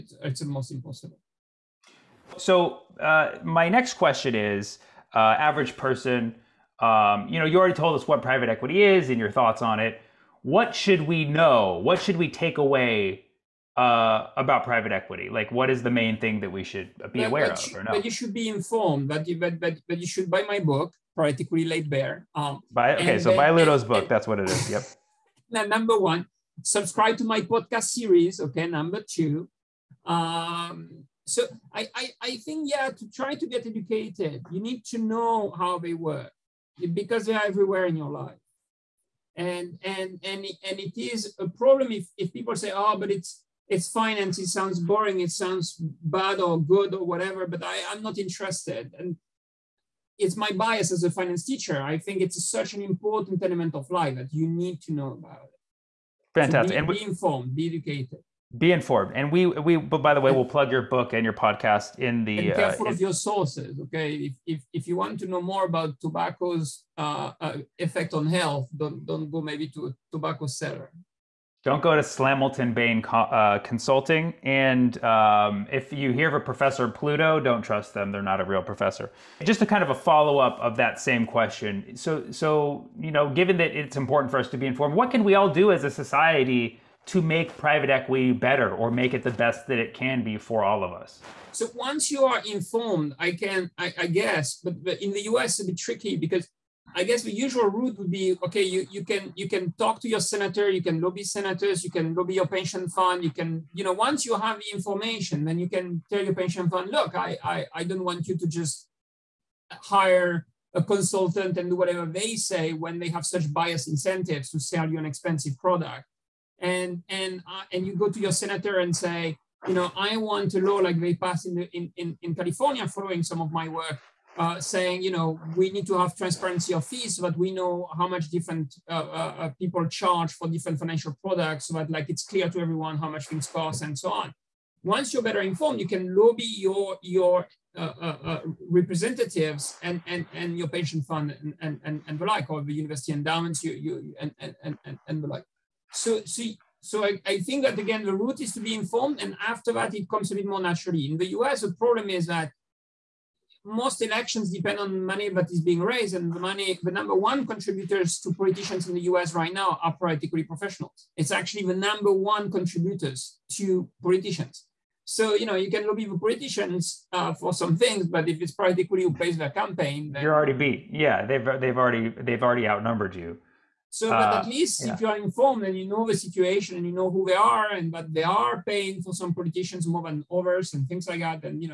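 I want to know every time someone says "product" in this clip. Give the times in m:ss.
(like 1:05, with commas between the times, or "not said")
1:55, 2:11.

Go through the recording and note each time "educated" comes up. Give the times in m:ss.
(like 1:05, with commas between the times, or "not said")
0:33, 0:57.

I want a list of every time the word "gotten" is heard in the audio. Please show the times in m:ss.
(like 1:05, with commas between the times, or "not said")
not said.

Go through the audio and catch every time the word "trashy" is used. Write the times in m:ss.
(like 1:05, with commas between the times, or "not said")
not said.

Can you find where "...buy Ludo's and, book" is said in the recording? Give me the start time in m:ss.
0:23.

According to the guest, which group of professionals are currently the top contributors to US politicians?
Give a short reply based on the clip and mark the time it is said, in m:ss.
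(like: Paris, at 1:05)
private equity professionals, at 2:39.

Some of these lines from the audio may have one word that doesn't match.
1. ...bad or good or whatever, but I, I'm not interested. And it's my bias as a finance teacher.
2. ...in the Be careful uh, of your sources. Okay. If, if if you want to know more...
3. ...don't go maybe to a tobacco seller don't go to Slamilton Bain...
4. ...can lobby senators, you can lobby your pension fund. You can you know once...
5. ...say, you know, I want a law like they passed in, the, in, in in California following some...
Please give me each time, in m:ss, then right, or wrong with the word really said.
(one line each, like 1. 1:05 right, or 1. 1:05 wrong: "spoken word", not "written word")
1. 0:45 right
2. 1:01 right
3. 1:09 right
4. 1:40 right
5. 1:58 right.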